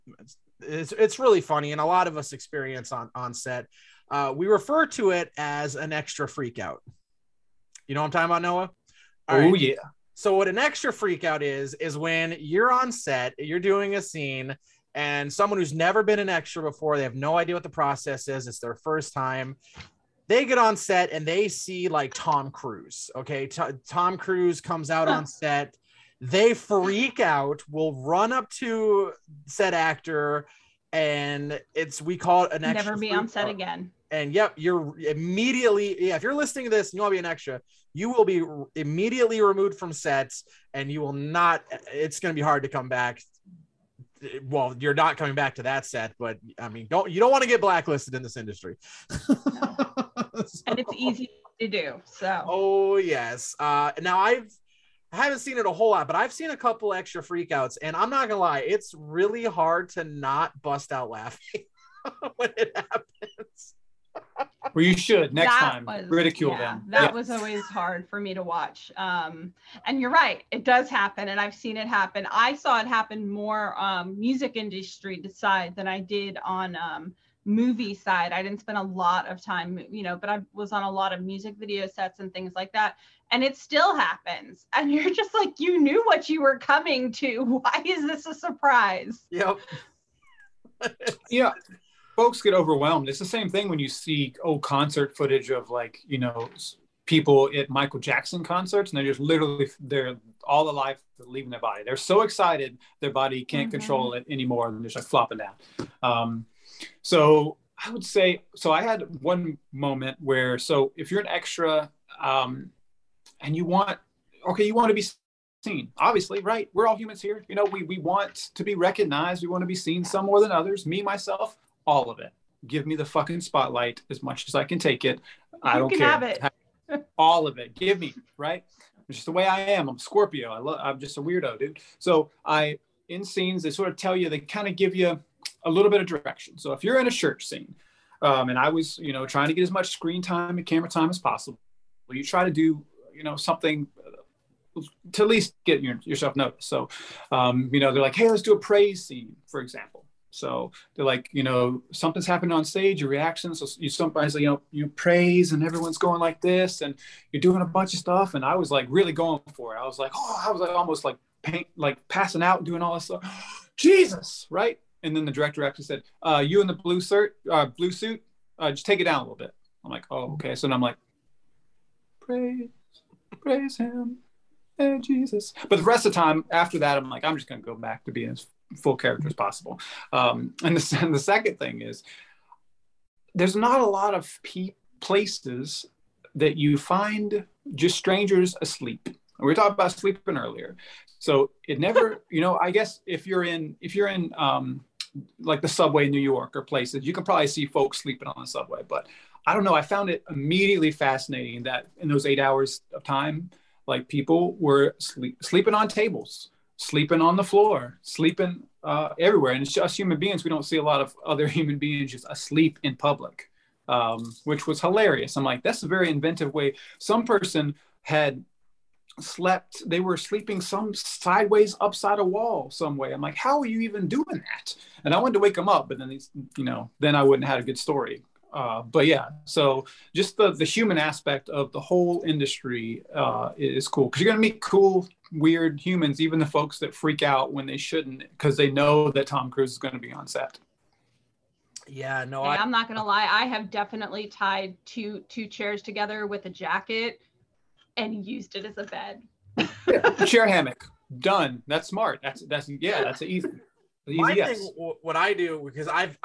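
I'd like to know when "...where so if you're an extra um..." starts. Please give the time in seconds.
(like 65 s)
110 s.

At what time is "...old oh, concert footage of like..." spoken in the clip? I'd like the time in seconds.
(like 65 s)
94 s.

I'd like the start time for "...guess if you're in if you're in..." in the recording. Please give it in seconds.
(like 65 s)
192 s.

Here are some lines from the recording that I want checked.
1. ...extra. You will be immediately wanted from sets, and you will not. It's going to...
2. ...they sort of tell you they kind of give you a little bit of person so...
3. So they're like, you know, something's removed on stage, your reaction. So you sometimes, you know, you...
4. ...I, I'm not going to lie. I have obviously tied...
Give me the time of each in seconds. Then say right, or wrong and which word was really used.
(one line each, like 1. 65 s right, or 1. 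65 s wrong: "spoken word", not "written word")
1. 37 s wrong: "removed", not "wanted"
2. 133 s wrong: "direction", not "person"
3. 150 s wrong: "happened", not "removed"
4. 242 s wrong: "definitely", not "obviously".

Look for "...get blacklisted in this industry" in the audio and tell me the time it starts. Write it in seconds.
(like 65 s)
47 s.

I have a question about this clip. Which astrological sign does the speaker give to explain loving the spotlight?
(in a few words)
Scorpio.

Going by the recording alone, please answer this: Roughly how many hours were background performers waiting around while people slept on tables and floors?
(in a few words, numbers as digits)
8.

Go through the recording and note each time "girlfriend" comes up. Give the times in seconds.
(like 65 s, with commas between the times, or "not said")
not said.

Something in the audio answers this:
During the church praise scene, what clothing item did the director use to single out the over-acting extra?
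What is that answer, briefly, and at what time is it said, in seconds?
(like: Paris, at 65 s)
blue suit, at 167 s.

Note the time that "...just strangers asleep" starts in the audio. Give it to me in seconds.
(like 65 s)
187 s.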